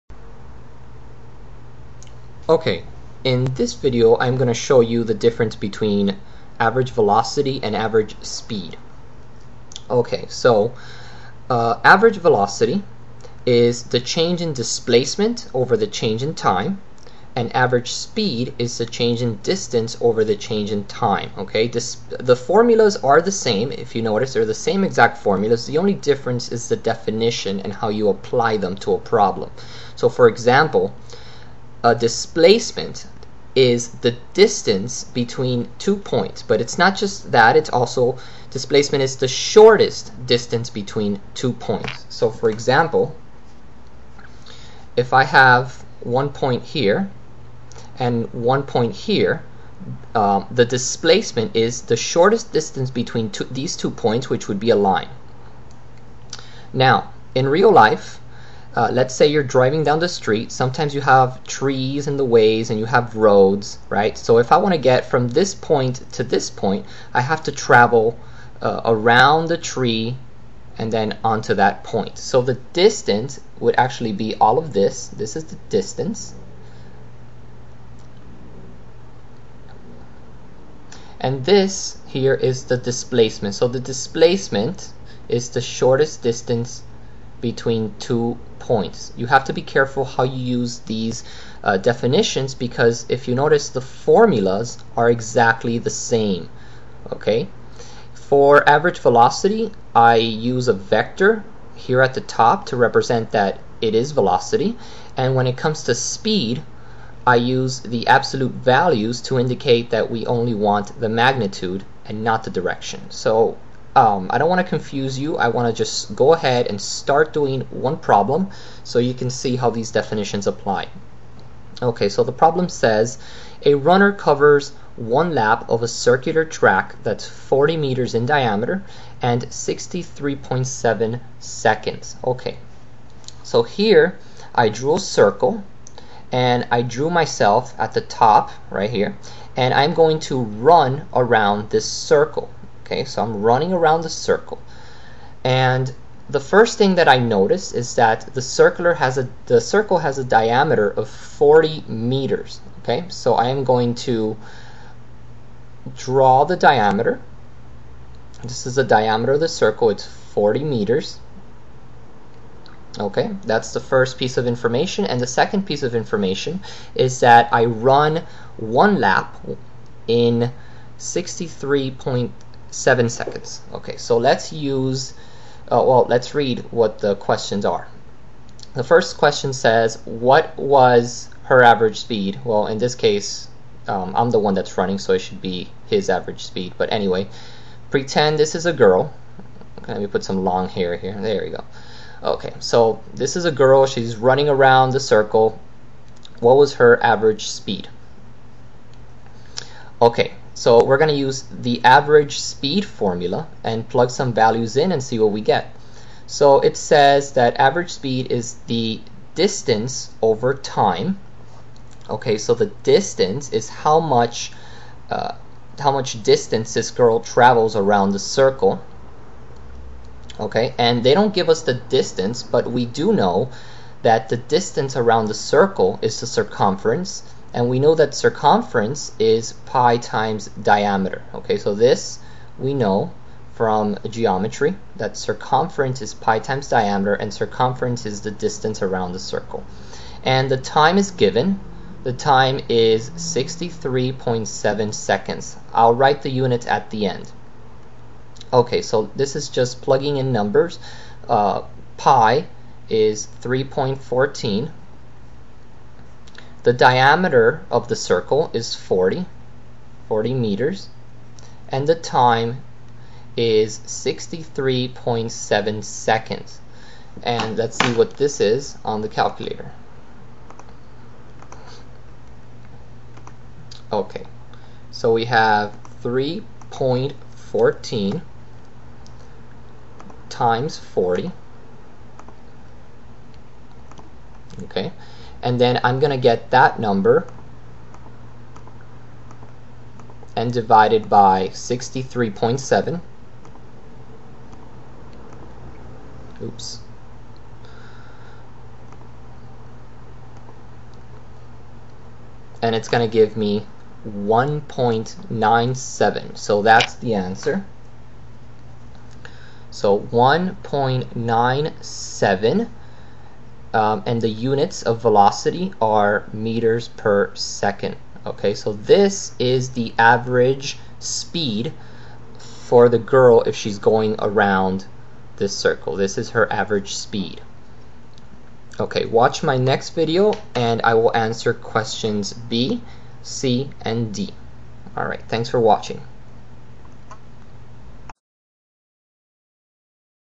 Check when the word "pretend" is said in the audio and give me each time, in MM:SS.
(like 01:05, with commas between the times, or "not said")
03:07.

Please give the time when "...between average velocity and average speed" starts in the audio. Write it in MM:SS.
00:05.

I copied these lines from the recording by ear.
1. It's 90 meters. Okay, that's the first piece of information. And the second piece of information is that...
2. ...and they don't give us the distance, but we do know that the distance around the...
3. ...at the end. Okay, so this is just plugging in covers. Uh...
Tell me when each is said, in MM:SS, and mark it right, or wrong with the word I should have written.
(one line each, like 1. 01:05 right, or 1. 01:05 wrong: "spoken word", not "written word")
1. 02:39 wrong: "40", not "90"
2. 03:40 right
3. 04:06 wrong: "numbers", not "covers".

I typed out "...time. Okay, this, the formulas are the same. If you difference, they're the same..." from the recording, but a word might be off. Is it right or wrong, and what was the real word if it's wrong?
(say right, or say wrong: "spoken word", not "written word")
wrong: "notice", not "difference".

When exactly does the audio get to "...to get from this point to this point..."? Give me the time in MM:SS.
01:04.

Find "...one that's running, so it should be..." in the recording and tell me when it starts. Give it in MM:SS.
03:04.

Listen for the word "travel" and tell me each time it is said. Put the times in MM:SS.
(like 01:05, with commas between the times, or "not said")
01:07, 03:37.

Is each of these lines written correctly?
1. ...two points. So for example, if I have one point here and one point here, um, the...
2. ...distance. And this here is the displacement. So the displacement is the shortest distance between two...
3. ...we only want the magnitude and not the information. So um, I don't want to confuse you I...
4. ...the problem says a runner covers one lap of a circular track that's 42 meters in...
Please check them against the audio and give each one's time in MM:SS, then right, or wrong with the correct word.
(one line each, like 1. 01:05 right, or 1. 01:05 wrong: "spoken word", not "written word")
1. 00:41 right
2. 01:15 right
3. 01:50 wrong: "direction", not "information"
4. 02:02 wrong: "40", not "42".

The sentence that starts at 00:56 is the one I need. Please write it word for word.
Now, in real life, uh, let's say you're driving down the street.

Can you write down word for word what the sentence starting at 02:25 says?
And the first thing that I notice is that the circular has a the circle has a diameter of 40 meters.